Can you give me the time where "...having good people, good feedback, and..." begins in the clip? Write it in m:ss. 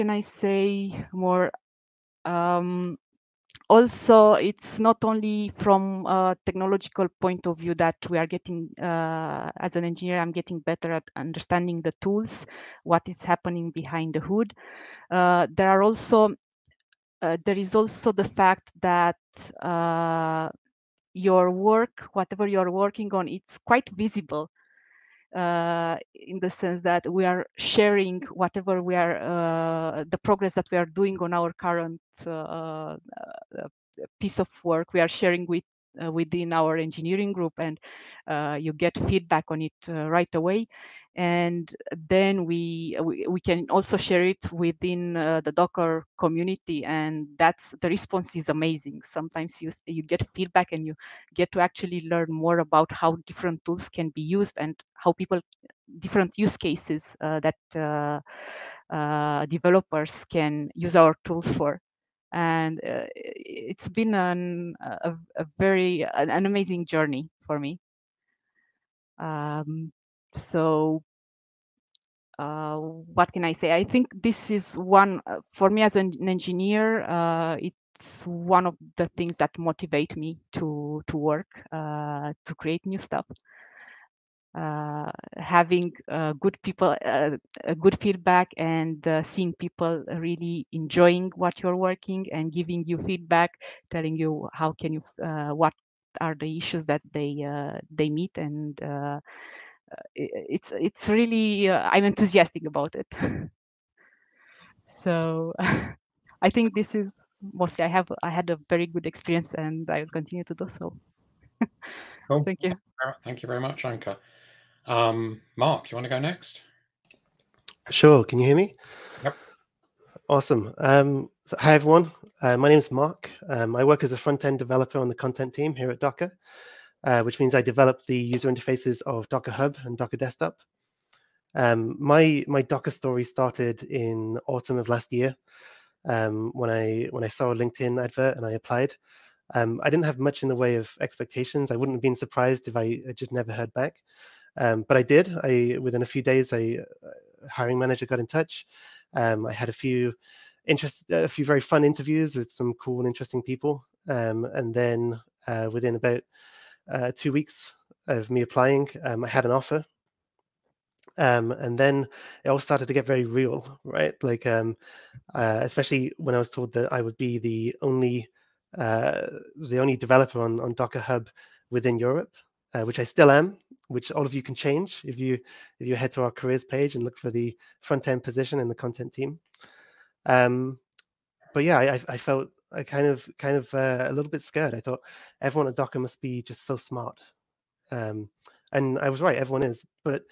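1:25.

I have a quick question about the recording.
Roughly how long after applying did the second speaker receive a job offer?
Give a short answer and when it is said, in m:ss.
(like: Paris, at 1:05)
2 weeks, at 2:37.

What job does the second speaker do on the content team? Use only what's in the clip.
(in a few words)
front end developer.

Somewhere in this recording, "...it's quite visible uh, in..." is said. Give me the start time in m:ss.
0:23.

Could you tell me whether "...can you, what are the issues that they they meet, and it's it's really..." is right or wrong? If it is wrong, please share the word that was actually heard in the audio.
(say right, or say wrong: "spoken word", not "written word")
right.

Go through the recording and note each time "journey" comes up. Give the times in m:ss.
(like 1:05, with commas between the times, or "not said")
1:06.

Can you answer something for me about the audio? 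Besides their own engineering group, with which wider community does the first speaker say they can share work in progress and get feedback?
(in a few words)
Docker community.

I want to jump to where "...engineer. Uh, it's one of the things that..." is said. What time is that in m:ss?
1:16.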